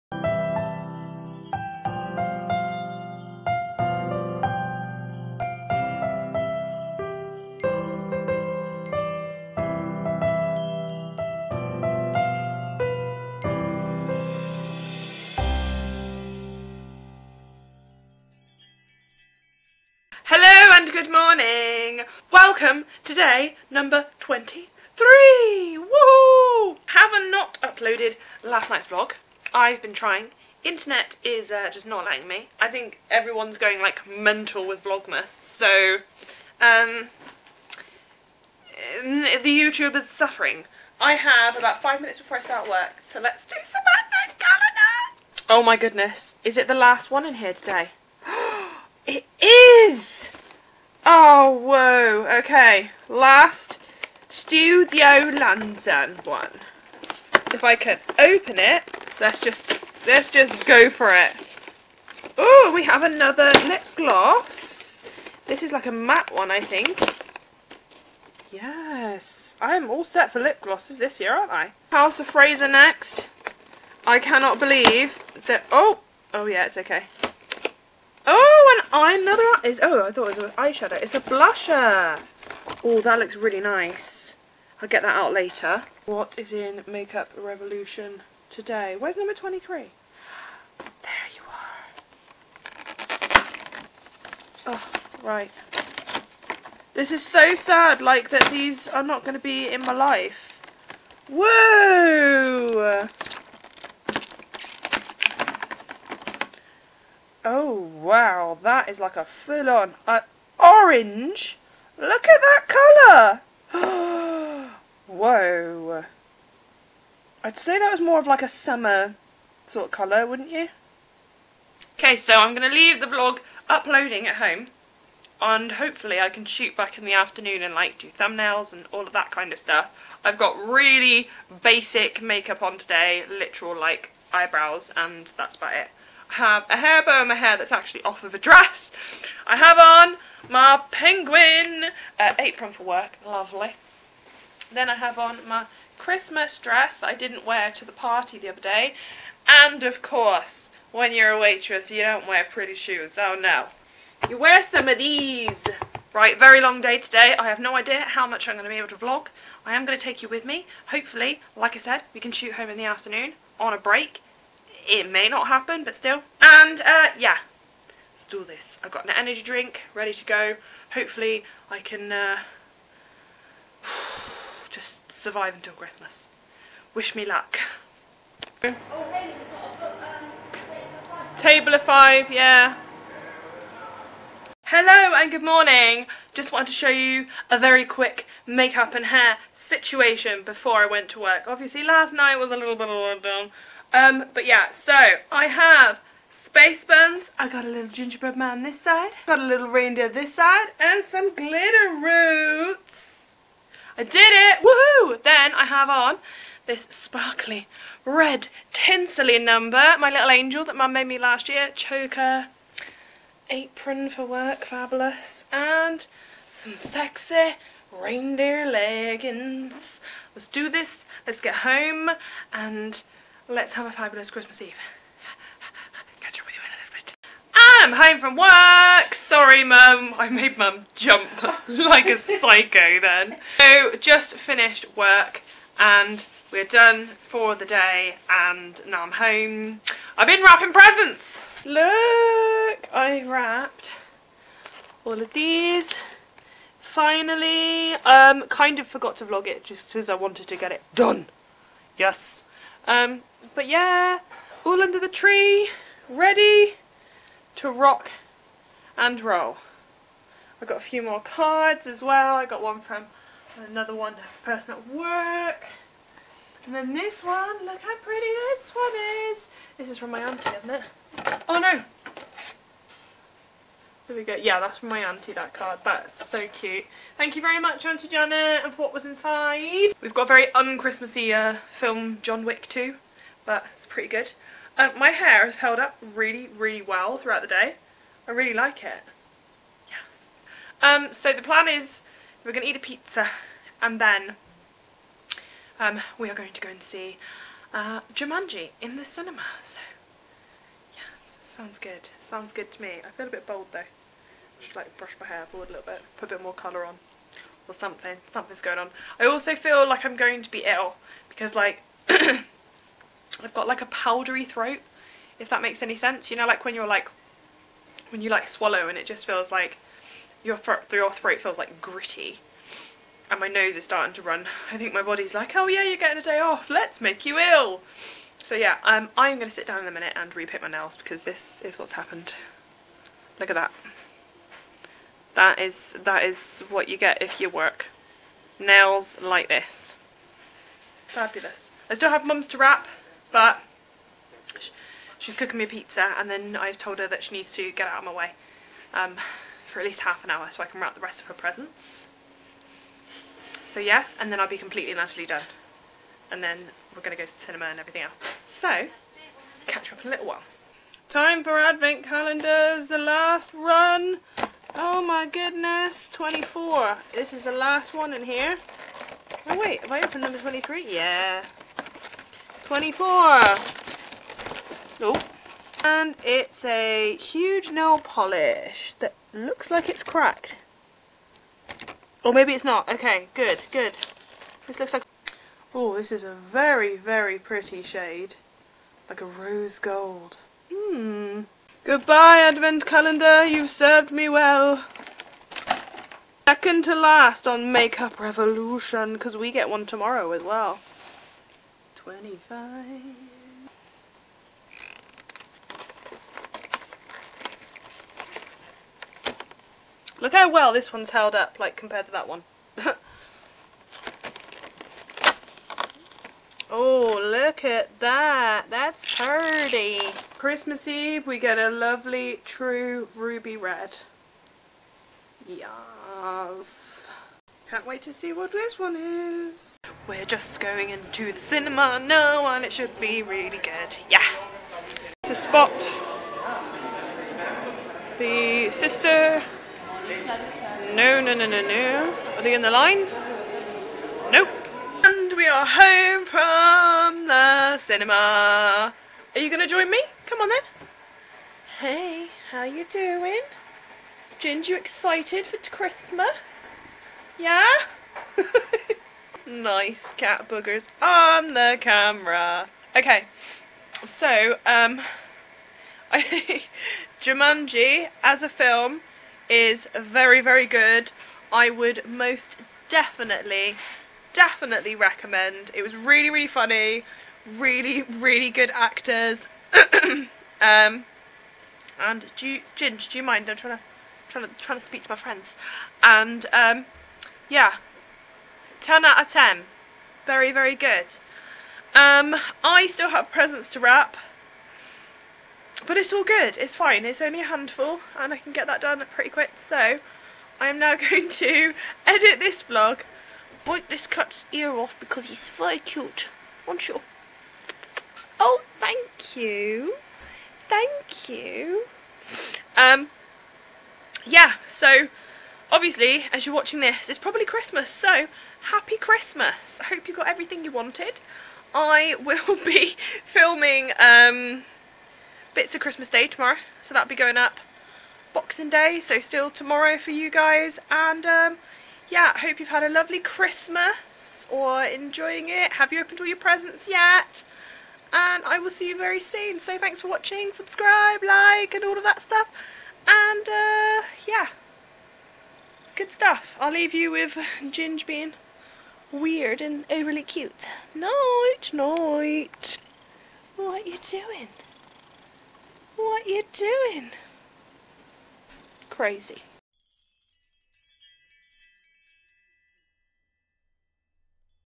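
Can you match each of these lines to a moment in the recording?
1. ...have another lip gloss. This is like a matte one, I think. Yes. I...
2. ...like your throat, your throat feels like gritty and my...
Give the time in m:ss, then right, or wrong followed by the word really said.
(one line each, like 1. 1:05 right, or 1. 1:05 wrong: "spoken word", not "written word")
1. 1:02 right
2. 5:19 right.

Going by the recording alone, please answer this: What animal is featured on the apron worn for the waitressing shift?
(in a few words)
Penguin.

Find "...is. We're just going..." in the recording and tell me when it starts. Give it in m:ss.
7:08.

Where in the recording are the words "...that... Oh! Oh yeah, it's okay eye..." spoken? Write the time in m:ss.
1:15.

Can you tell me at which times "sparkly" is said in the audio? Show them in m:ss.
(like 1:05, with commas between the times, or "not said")
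3:26.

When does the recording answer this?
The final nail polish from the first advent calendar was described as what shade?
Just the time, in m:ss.
6:29.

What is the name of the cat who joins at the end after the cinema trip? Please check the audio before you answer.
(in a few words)
Ginger.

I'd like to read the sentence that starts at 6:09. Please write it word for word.
Oh wait, have I opened number 23?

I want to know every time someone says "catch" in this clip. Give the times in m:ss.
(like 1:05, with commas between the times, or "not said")
3:46, 5:59.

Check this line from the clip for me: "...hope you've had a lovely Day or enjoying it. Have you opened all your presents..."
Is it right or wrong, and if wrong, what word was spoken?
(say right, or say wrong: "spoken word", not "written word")
wrong: "Christmas", not "Day".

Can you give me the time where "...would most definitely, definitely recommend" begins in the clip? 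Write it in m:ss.
7:51.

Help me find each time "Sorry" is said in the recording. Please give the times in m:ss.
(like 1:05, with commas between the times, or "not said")
3:49.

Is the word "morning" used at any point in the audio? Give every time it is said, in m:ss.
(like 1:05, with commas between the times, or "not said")
0:21, 3:05.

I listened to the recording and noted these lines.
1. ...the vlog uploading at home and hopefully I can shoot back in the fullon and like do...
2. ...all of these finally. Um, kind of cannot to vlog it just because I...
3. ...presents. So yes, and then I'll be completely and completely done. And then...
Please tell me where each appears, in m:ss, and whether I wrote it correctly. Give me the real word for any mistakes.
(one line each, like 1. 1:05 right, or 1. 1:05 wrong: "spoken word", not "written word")
1. 2:02 wrong: "afternoon", not "fullon"
2. 4:05 wrong: "forgot", not "cannot"
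3. 5:51 wrong: "utterly", not "completely".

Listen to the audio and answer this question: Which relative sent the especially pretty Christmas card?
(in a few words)
Auntie Janet.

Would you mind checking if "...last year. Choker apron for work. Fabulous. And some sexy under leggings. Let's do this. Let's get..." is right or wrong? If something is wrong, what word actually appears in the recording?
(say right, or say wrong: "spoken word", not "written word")
wrong: "reindeer", not "under".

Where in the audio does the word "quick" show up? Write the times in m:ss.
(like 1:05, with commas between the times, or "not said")
3:07, 8:19.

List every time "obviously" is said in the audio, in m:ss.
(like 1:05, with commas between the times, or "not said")
3:11, 8:35.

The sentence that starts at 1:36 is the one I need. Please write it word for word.
This is so sad, like, that these are not going to be in my life.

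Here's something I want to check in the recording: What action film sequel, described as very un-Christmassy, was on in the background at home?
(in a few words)
John Wick 2.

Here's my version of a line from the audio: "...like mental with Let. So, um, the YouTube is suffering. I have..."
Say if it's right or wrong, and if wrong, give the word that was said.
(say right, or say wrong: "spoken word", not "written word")
wrong: "Vlogmas", not "Let".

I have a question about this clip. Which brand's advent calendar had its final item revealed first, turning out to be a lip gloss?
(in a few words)
Studio London.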